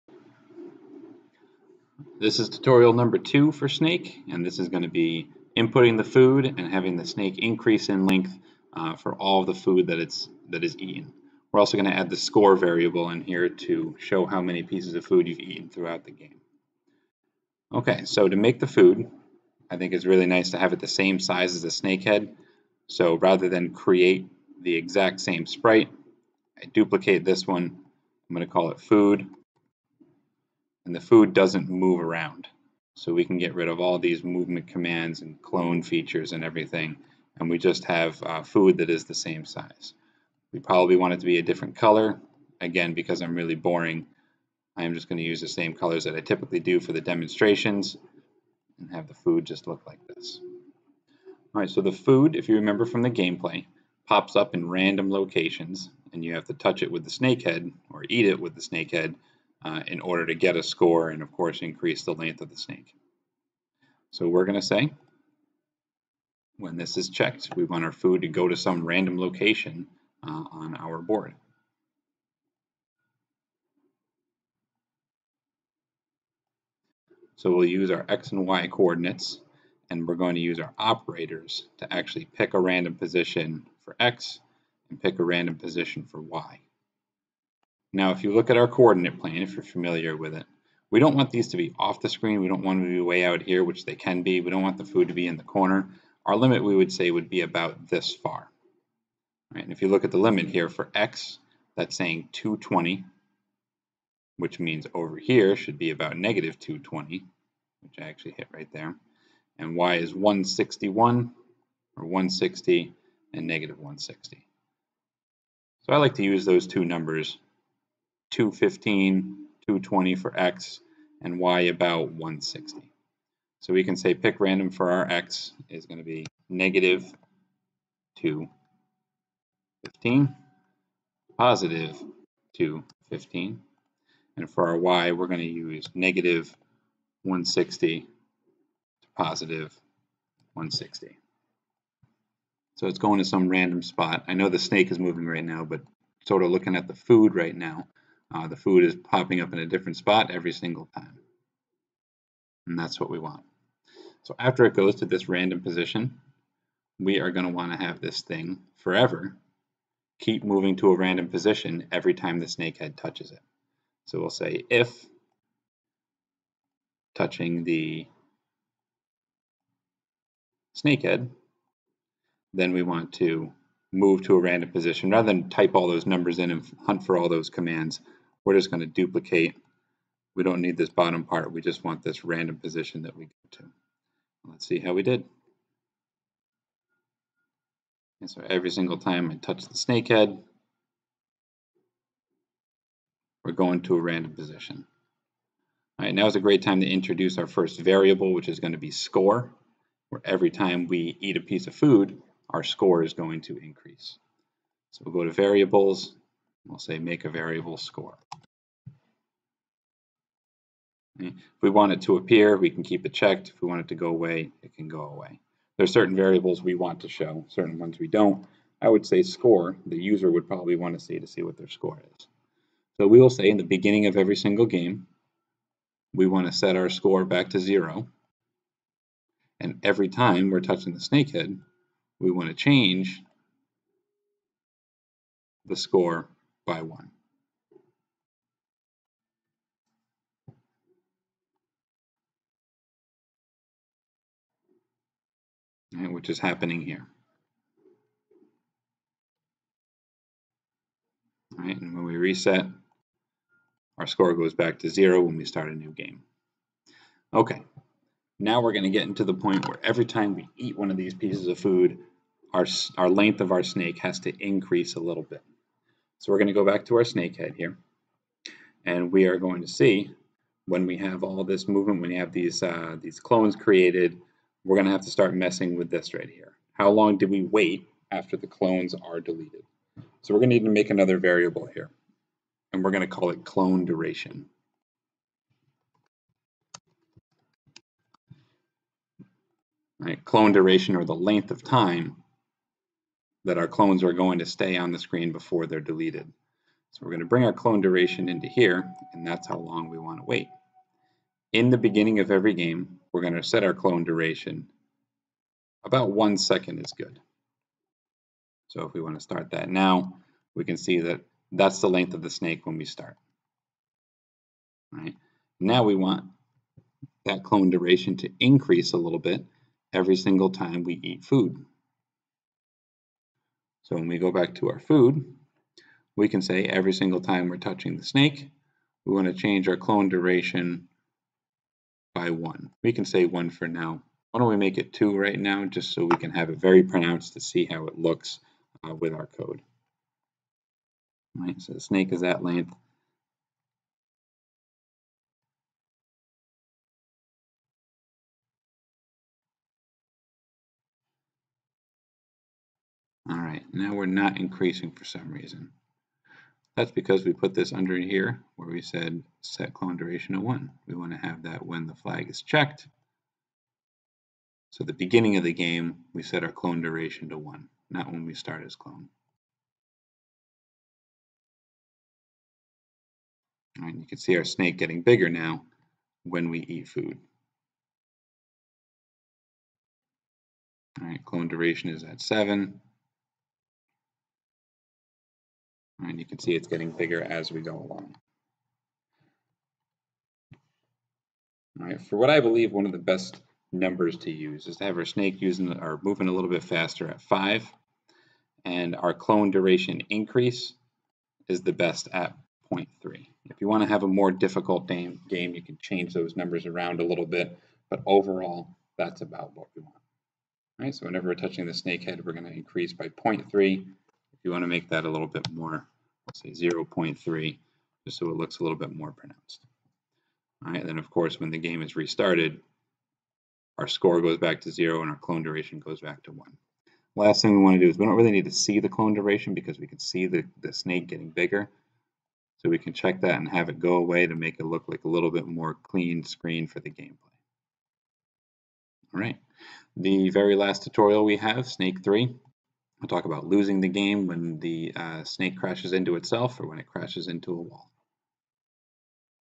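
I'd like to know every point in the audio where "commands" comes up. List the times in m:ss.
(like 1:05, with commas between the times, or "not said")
0:34, 2:57.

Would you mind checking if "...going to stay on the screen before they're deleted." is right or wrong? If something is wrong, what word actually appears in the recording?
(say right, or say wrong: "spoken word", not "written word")
right.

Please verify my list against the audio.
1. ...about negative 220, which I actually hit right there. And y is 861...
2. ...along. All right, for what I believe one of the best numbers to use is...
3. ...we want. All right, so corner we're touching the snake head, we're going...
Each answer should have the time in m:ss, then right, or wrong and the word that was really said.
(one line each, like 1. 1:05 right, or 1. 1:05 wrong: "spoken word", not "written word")
1. 1:45 wrong: "161", not "861"
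2. 6:27 right
3. 6:49 wrong: "whenever", not "corner".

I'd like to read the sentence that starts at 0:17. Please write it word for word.
Okay, so to make the food, I think it's really nice to have it the same size as the snake head.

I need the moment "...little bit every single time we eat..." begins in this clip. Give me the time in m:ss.
5:18.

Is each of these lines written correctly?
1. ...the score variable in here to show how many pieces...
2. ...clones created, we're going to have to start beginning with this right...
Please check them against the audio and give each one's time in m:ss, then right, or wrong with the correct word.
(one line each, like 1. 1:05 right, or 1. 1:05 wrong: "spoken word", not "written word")
1. 0:12 right
2. 4:33 wrong: "messing", not "beginning".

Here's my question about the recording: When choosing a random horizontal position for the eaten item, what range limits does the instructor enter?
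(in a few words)
-215 to 215.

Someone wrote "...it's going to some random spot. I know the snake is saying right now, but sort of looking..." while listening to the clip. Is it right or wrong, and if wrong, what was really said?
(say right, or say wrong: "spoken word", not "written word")
wrong: "moving", not "saying".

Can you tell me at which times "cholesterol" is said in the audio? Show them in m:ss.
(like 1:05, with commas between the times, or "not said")
not said.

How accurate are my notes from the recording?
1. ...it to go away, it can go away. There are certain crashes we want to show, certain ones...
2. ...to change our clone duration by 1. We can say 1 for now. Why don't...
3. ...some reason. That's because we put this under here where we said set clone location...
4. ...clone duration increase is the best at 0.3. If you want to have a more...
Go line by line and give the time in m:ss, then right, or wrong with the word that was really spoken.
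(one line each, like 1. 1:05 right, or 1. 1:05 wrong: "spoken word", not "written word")
1. 3:33 wrong: "variables", not "crashes"
2. 5:29 right
3. 5:55 wrong: "duration", not "location"
4. 6:39 right.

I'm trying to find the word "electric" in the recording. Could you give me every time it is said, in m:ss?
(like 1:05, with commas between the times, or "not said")
not said.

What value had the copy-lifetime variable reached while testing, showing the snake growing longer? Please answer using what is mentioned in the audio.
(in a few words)
7.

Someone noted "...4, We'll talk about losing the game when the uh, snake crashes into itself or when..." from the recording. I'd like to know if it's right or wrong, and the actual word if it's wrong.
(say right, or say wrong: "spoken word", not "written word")
wrong: "3", not "4".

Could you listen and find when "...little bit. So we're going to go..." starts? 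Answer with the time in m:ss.
4:24.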